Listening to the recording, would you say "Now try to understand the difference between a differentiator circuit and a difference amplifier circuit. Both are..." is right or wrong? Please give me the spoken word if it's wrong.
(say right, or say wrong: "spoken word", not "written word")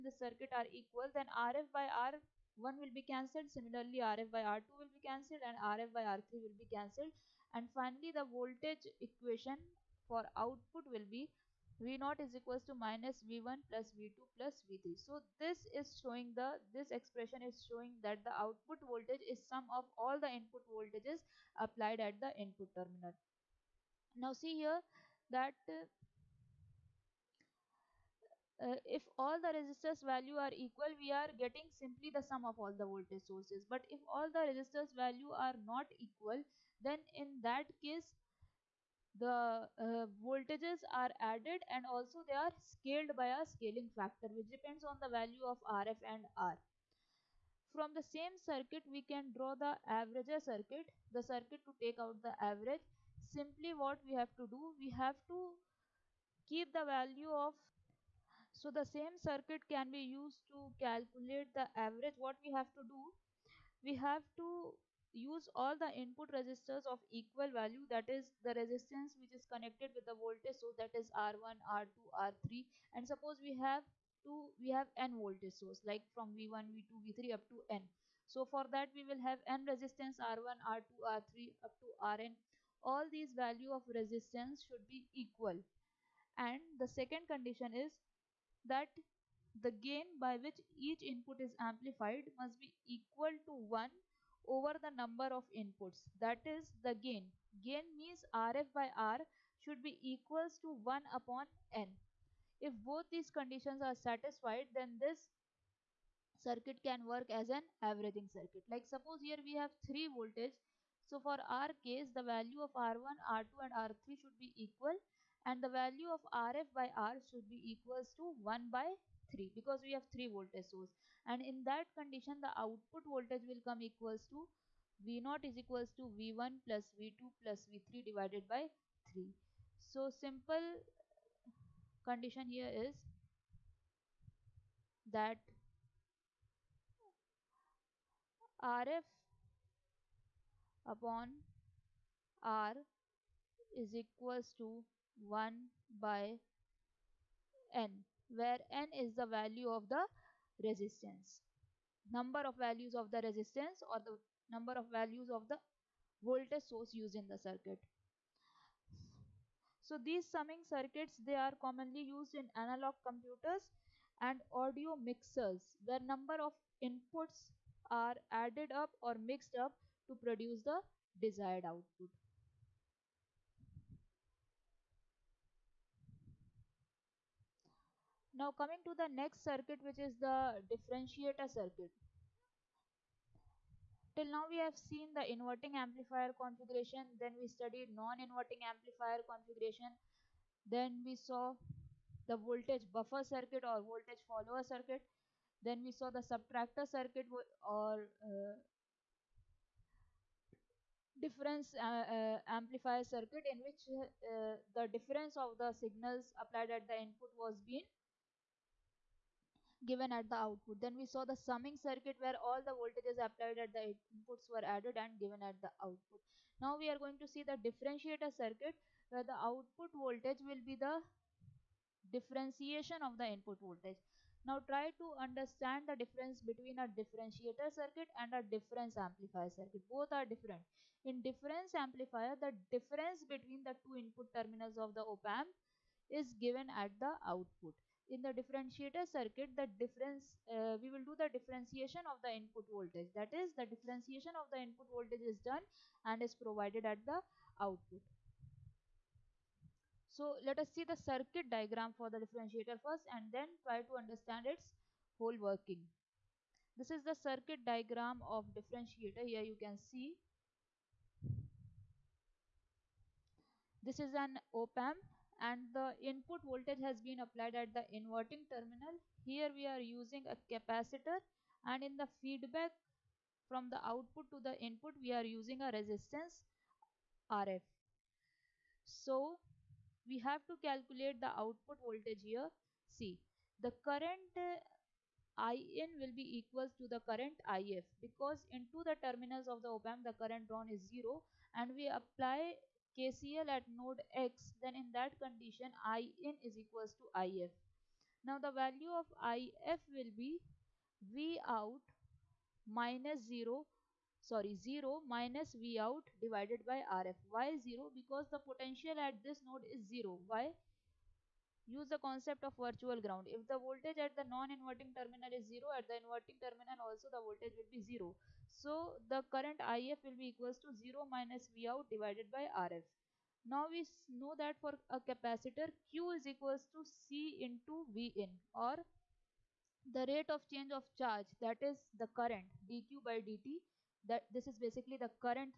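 right.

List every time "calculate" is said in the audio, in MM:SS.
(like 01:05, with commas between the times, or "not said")
01:00, 04:40.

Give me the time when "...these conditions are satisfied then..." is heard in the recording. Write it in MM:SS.
01:43.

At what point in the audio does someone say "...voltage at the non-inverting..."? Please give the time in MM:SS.
05:13.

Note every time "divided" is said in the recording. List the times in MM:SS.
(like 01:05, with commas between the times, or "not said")
02:08, 05:06, 05:21.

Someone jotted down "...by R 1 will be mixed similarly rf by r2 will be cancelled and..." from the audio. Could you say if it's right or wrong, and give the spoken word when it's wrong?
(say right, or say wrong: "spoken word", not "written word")
wrong: "cancelled", not "mixed".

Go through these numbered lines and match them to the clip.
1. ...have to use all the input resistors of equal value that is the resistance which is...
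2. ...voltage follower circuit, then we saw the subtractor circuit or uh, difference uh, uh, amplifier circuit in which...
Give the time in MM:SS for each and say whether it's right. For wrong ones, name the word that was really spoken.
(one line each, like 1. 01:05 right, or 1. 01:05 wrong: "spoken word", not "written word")
1. 01:03 right
2. 03:13 right.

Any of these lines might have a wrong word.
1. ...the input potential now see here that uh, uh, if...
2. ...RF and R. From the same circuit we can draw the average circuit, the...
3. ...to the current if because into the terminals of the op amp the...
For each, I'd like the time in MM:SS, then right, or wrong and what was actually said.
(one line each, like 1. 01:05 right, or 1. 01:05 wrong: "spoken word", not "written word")
1. 00:22 wrong: "terminal", not "potential"
2. 00:45 right
3. 04:46 right.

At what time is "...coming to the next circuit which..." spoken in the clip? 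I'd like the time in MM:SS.
02:58.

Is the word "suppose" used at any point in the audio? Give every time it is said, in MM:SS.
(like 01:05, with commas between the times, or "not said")
01:13, 01:48.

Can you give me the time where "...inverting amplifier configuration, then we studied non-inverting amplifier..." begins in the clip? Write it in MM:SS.
03:05.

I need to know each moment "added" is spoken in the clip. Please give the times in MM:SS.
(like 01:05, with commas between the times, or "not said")
00:41, 02:48, 03:34.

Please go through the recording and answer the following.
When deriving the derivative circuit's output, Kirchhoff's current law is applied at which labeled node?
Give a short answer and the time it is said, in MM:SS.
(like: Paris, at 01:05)
Node X, at 04:53.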